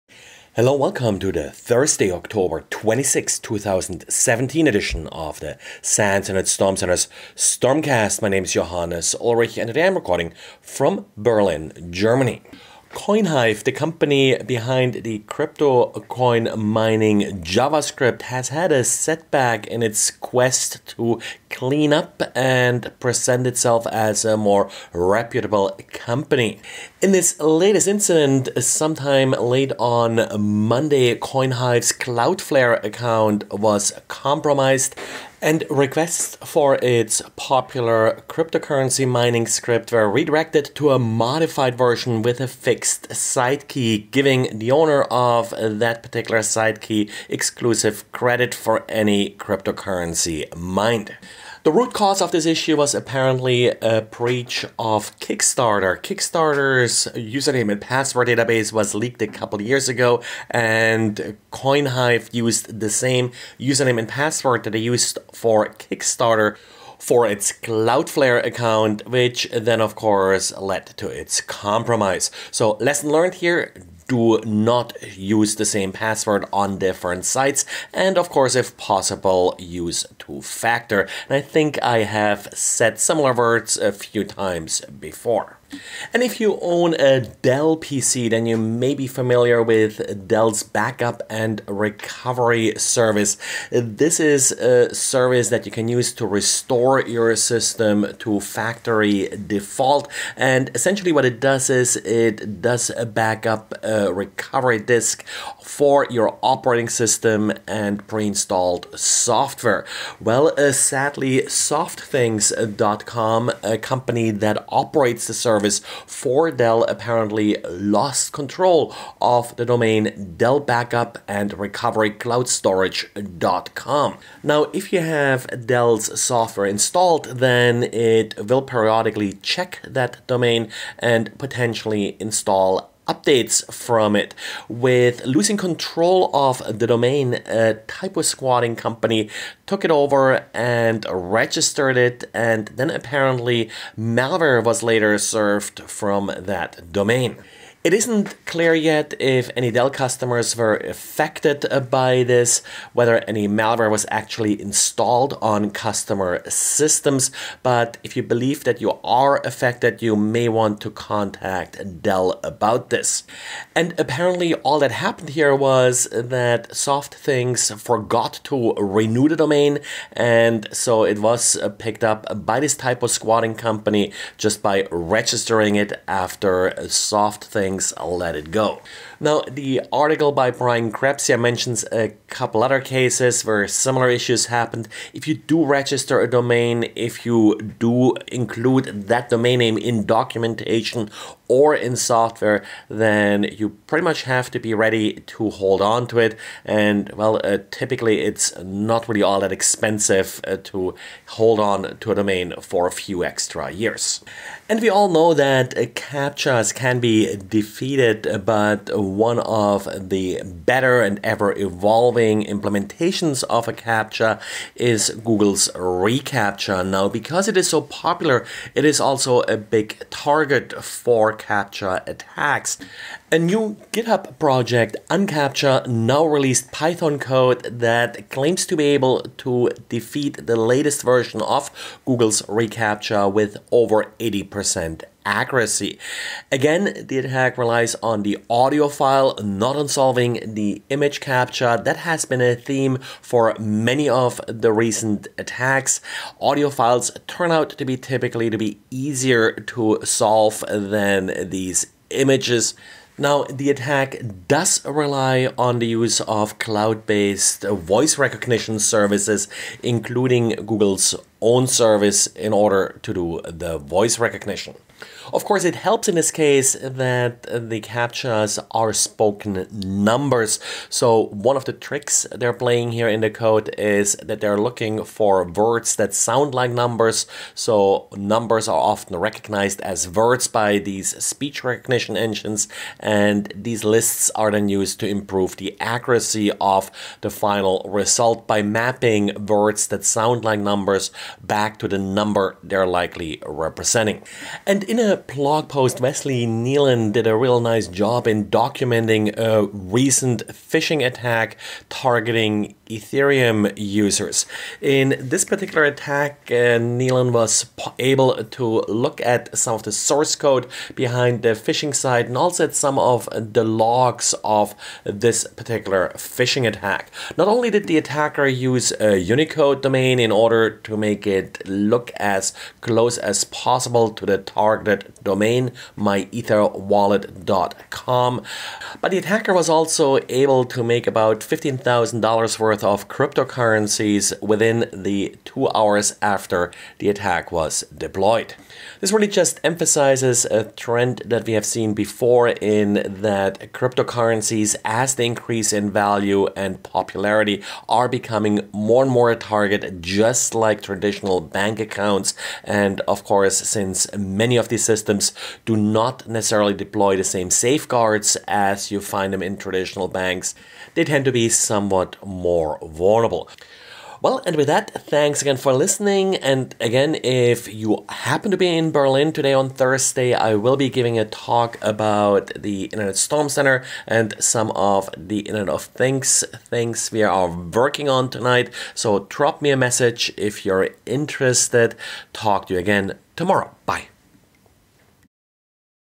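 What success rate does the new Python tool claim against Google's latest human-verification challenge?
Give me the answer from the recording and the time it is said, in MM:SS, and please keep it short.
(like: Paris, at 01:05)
over 80%, at 03:53.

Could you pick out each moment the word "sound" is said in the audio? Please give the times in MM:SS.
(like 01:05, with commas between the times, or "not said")
04:36, 04:50.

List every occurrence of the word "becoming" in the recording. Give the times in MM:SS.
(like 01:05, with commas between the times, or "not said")
05:48.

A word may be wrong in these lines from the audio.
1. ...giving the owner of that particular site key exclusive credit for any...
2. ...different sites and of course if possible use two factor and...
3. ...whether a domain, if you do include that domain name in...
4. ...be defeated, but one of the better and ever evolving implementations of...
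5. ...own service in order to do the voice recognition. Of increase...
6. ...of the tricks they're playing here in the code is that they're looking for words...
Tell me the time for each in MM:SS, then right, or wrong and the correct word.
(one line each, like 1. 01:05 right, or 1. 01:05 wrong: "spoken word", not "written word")
1. 00:44 right
2. 01:16 right
3. 03:05 wrong: "register", not "whether"
4. 03:27 right
5. 04:21 wrong: "course", not "increase"
6. 04:31 right.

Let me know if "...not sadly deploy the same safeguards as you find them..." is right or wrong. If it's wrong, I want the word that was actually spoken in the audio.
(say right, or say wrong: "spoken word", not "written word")
wrong: "necessarily", not "sadly".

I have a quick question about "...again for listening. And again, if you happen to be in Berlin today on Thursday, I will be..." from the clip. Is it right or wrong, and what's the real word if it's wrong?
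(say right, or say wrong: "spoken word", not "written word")
right.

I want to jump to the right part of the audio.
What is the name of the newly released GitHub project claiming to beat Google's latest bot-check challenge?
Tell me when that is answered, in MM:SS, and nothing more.
03:45.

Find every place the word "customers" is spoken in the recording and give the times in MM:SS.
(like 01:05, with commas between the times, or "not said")
02:29, 02:35.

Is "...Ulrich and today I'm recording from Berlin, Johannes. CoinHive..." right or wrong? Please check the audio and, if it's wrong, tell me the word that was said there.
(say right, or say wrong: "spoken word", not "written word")
wrong: "Germany", not "Johannes".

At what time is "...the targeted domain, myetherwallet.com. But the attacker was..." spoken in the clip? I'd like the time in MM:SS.
05:24.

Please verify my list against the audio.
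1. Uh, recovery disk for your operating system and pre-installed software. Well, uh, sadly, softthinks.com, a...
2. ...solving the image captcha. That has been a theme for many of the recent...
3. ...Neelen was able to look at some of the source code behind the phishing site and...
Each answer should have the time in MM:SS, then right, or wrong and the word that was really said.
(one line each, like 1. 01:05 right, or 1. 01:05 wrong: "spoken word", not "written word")
1. 01:43 right
2. 03:59 right
3. 05:06 right.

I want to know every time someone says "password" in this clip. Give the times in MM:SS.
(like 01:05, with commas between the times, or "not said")
00:57, 01:04, 01:15.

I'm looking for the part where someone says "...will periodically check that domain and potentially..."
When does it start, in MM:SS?
02:08.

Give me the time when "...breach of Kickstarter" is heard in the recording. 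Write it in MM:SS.
00:54.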